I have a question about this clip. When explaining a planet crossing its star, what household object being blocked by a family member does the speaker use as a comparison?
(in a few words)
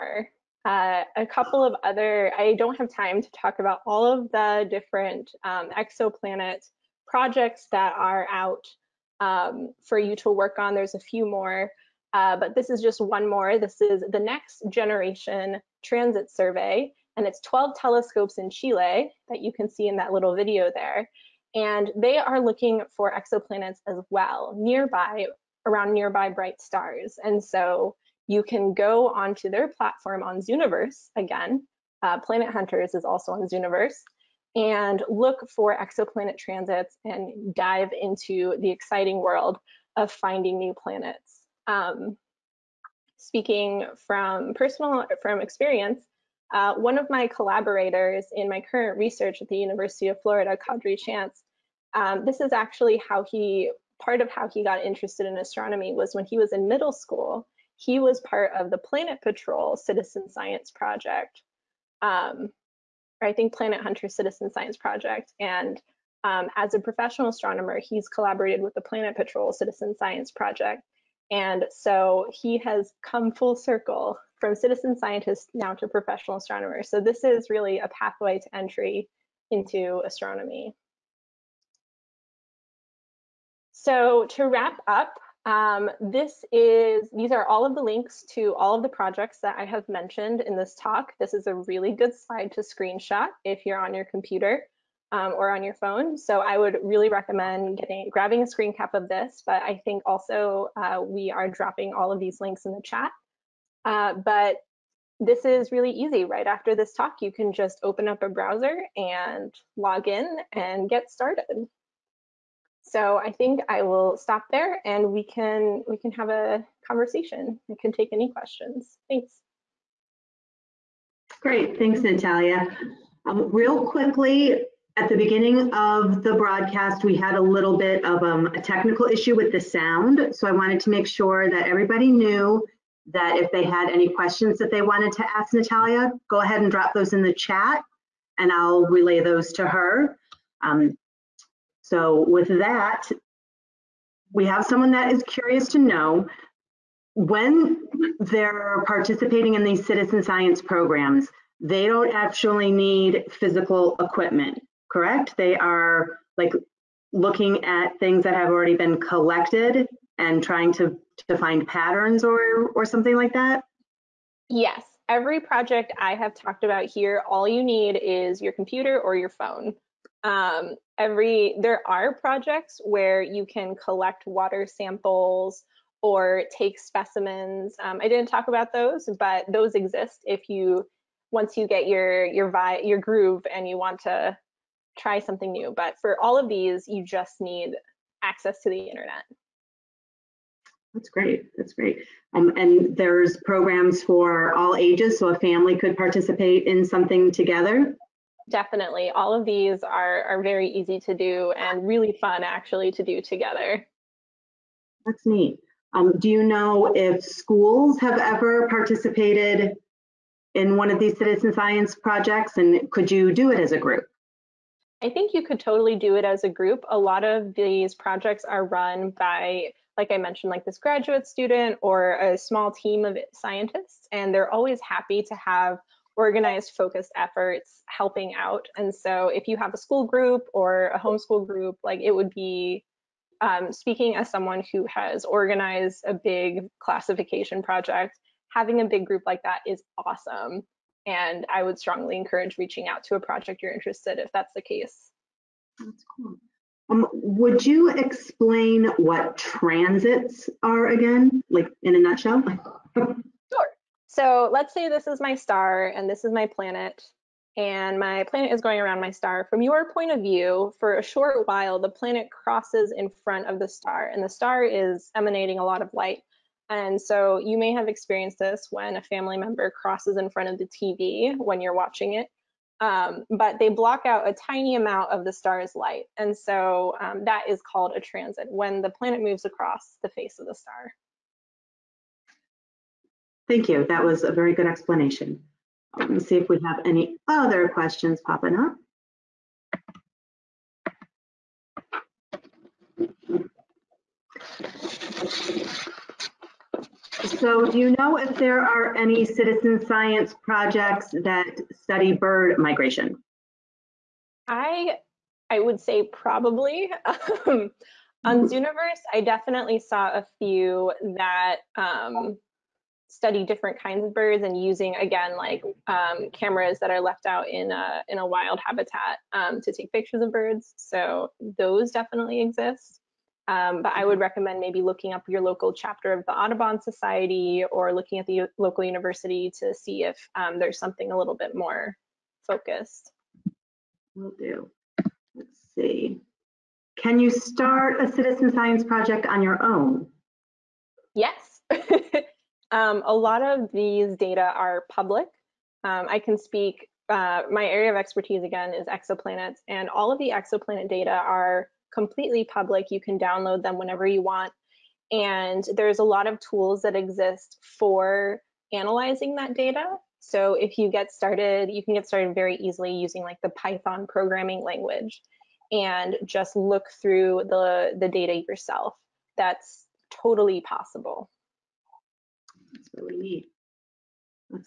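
TV.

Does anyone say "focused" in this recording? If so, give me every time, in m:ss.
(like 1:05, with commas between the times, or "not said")
3:46, 5:32.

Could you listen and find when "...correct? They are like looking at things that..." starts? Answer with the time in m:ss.
2:34.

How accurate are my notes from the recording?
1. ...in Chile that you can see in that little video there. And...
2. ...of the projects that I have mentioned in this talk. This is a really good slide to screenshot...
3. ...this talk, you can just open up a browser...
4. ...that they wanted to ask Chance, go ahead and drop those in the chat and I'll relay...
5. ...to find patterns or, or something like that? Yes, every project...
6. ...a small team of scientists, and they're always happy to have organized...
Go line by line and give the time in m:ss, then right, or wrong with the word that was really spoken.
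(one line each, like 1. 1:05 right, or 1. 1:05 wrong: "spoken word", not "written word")
1. 0:18 right
2. 1:28 right
3. 1:46 right
4. 2:14 wrong: "Natalia", not "Chance"
5. 2:41 right
6. 3:42 right.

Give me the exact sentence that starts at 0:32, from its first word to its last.
Uh, Planet Hunters is also on Zooniverse and look for exoplanet transits and dive into the exciting world of finding new planets.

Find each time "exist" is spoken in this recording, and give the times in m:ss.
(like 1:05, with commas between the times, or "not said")
2:59, 5:22, 5:56.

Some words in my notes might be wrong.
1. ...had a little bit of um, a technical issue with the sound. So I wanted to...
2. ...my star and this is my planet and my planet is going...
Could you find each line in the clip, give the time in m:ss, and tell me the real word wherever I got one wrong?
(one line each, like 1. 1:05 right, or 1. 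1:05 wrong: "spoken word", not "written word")
1. 2:07 right
2. 4:15 right.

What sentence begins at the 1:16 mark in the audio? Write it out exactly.
So this is really a pathway to entry into astronomy.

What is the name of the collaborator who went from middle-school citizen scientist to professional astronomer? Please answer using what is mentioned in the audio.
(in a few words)
Quadry Chance.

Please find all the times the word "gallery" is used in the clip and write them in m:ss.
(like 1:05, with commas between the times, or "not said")
not said.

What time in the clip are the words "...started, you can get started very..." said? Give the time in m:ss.
6:01.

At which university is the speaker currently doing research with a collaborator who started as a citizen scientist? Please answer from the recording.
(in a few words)
University of Florida.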